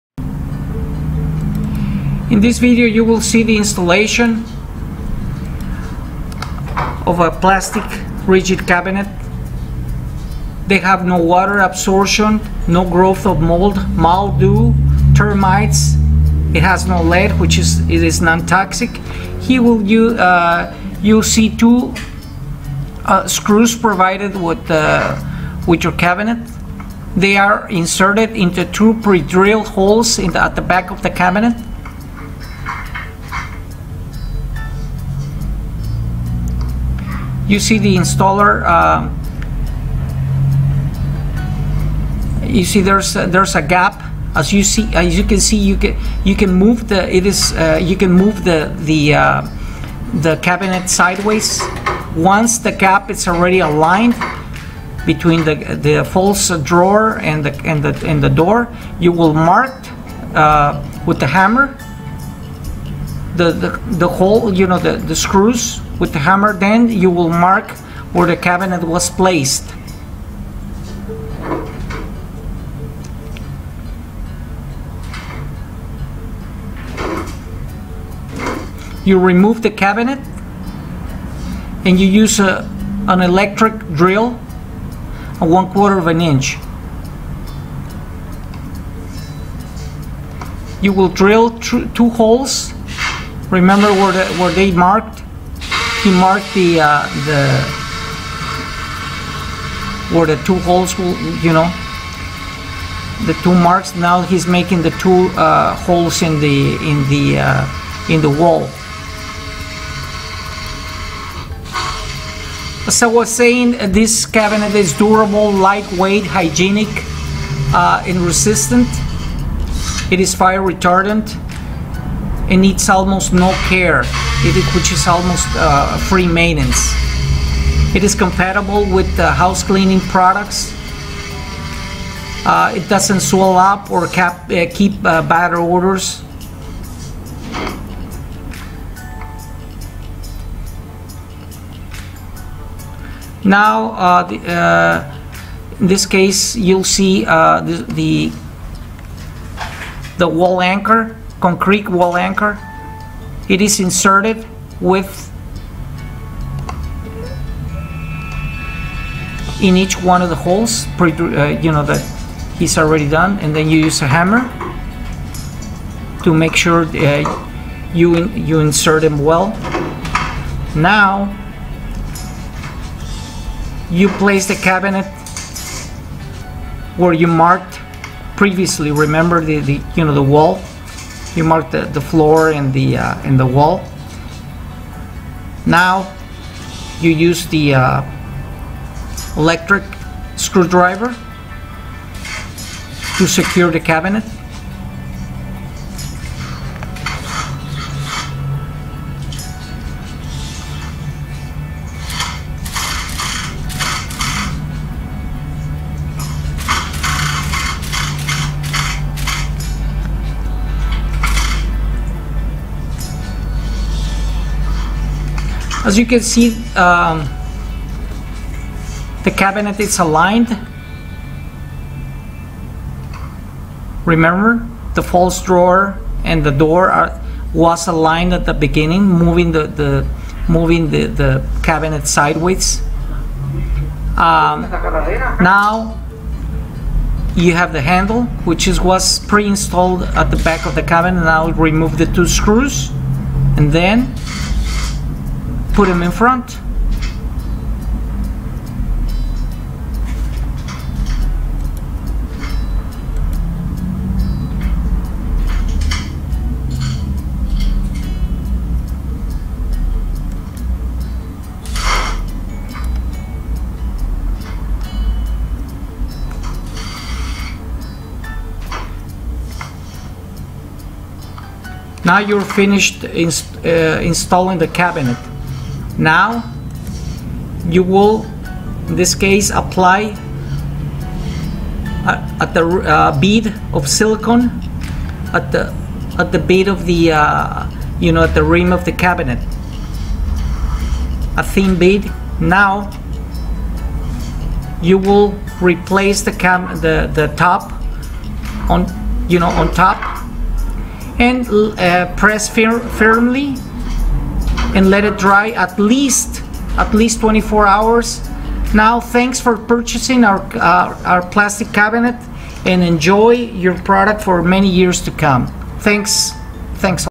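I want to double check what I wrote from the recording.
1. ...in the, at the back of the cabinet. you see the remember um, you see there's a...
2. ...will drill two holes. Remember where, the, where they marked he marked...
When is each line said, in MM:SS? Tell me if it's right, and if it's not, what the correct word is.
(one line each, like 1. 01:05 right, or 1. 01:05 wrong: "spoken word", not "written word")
1. 00:30 wrong: "installer", not "remember"
2. 01:30 right.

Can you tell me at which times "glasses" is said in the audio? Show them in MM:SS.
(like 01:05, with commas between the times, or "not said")
not said.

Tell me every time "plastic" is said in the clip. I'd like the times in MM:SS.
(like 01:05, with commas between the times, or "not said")
00:07, 05:11.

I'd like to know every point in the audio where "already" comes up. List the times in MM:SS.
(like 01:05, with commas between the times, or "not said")
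00:53, 02:42.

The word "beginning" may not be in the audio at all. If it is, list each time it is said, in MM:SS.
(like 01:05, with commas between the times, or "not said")
03:48.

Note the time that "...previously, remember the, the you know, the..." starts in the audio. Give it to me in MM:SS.
02:58.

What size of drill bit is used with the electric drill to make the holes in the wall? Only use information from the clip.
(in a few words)
1/4 inch.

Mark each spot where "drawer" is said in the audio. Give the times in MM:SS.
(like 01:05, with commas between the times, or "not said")
00:56, 03:45.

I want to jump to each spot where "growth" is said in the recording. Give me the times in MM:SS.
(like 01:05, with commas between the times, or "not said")
00:12.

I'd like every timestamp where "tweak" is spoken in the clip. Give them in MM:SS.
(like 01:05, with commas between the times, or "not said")
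not said.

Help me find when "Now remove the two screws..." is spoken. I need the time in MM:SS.
04:01.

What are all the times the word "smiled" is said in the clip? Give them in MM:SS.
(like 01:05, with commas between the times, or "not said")
not said.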